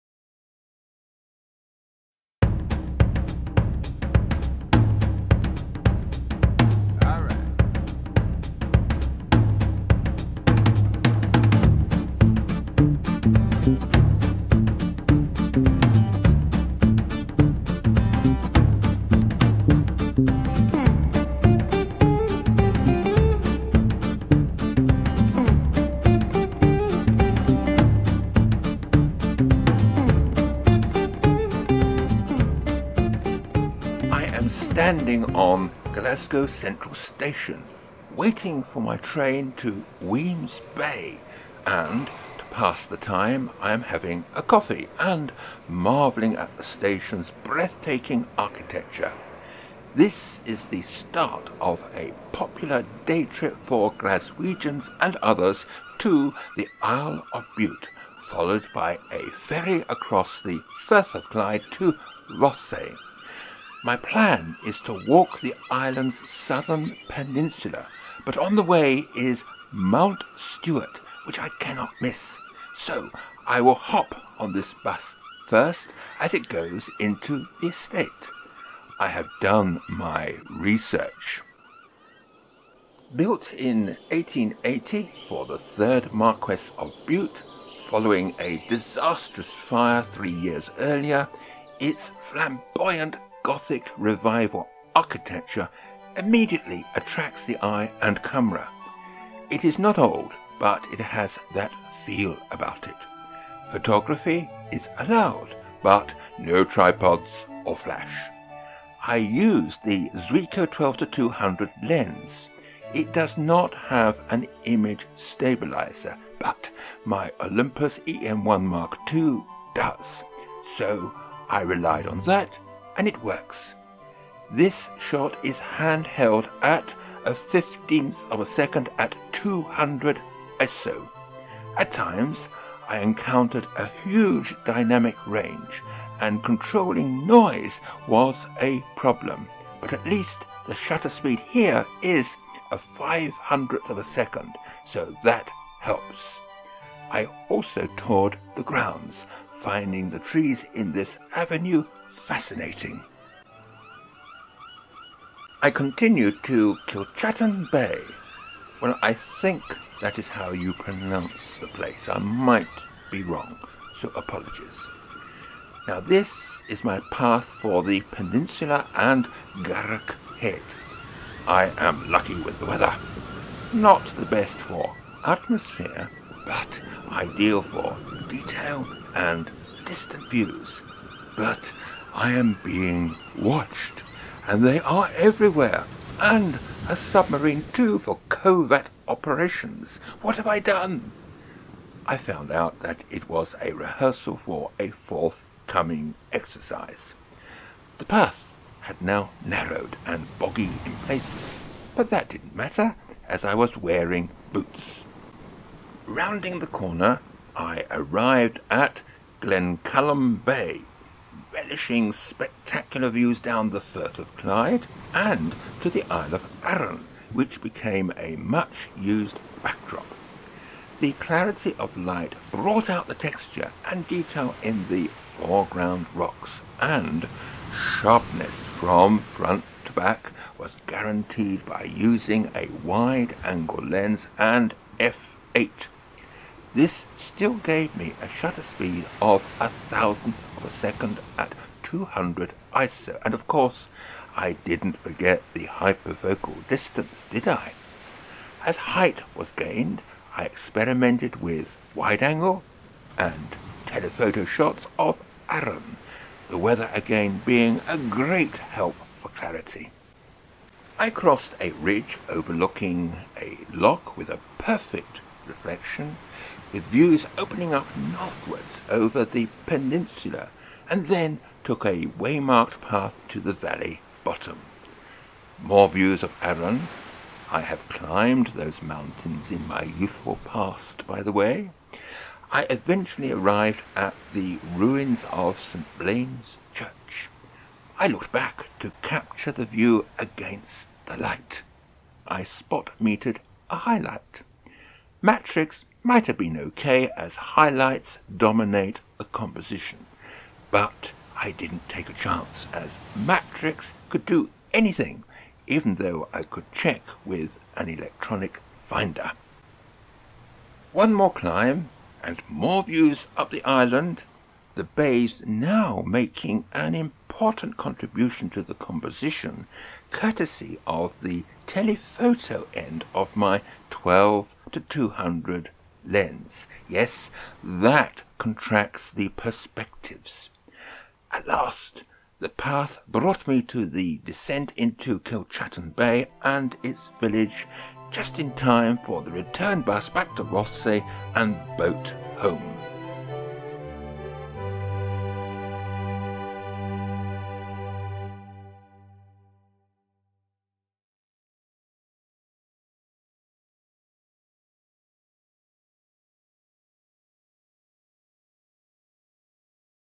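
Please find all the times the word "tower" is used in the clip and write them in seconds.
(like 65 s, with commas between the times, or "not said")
not said.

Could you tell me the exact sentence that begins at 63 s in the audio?
My plan is to walk the island's southern peninsula, but on the way is Mount Stuart, which I cannot miss.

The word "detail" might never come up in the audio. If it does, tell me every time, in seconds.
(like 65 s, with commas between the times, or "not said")
178 s, 224 s.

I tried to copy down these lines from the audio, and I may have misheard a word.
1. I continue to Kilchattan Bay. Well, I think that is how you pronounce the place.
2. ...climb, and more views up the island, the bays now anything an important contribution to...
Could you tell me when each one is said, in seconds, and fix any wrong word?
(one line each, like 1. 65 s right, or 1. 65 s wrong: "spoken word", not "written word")
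1. 155 s right
2. 311 s wrong: "making", not "anything".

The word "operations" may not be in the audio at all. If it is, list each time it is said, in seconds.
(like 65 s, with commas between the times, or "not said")
189 s.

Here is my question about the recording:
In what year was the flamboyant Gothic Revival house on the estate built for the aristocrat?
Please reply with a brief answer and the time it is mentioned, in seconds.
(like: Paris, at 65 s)
1880, at 84 s.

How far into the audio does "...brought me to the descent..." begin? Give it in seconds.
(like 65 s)
333 s.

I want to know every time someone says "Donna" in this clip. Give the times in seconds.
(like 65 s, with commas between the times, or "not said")
not said.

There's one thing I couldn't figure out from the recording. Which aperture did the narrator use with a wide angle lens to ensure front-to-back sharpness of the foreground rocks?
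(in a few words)
f8.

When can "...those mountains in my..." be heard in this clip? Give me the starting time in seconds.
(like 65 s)
278 s.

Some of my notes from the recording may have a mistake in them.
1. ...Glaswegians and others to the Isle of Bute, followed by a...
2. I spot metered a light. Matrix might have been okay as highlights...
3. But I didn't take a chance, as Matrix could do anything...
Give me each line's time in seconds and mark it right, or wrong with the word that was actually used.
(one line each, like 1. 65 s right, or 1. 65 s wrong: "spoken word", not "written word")
1. 53 s right
2. 292 s wrong: "highlight", not "light"
3. 300 s right.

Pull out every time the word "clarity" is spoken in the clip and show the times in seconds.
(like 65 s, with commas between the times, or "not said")
221 s, 259 s.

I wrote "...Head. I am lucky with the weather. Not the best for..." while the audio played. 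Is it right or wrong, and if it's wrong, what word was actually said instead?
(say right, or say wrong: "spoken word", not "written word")
right.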